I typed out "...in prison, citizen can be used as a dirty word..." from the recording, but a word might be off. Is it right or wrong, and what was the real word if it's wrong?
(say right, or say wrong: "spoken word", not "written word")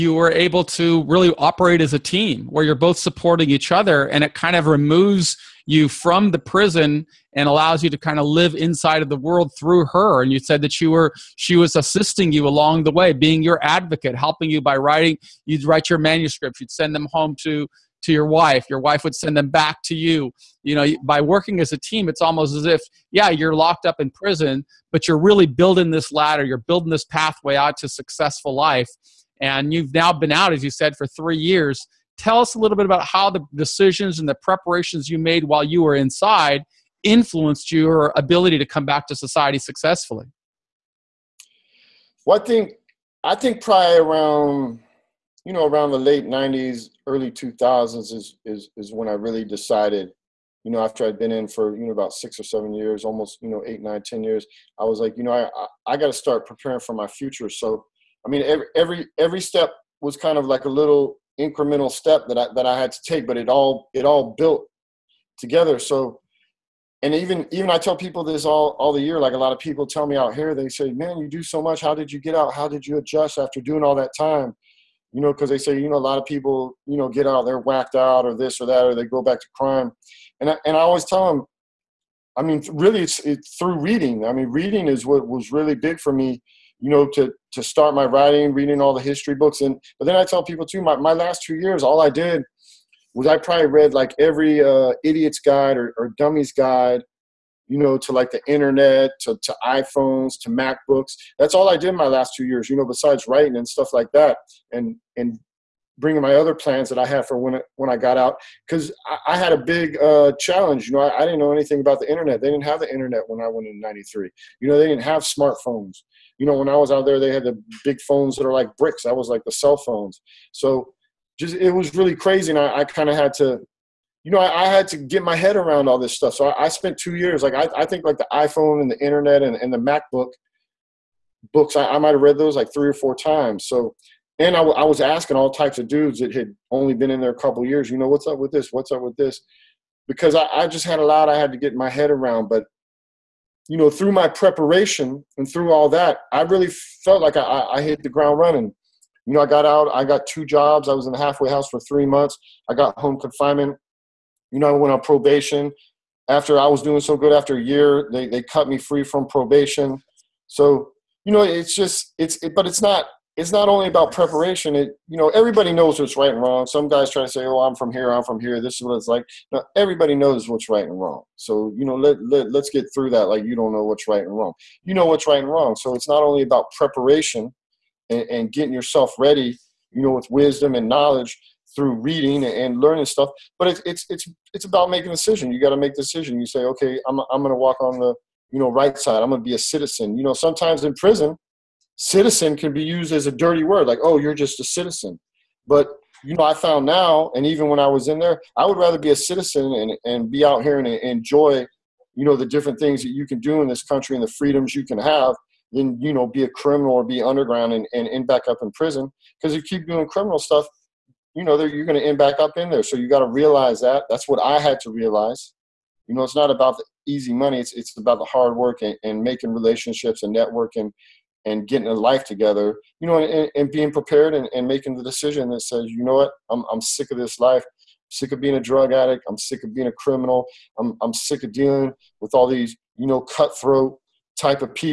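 right.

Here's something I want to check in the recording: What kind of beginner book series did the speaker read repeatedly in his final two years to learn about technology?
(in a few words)
Idiot's guide.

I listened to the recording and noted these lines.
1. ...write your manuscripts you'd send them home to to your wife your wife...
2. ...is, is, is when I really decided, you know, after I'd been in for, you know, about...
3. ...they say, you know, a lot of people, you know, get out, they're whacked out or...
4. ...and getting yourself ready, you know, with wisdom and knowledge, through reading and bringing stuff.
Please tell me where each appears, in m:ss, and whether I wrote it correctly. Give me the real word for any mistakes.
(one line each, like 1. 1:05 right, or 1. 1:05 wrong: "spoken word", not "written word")
1. 0:15 right
2. 0:48 right
3. 1:15 right
4. 2:58 wrong: "learning", not "bringing".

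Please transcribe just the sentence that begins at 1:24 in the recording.
I mean, reading is what was really big for me, you know, to, to start my writing, reading all the history books.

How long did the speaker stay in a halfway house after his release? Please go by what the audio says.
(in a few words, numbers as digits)
3 months.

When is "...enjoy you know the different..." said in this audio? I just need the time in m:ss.
3:21.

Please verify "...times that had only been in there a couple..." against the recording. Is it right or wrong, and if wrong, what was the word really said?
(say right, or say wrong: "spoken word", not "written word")
wrong: "dudes", not "times".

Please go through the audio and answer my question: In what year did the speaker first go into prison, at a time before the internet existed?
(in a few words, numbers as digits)
1993.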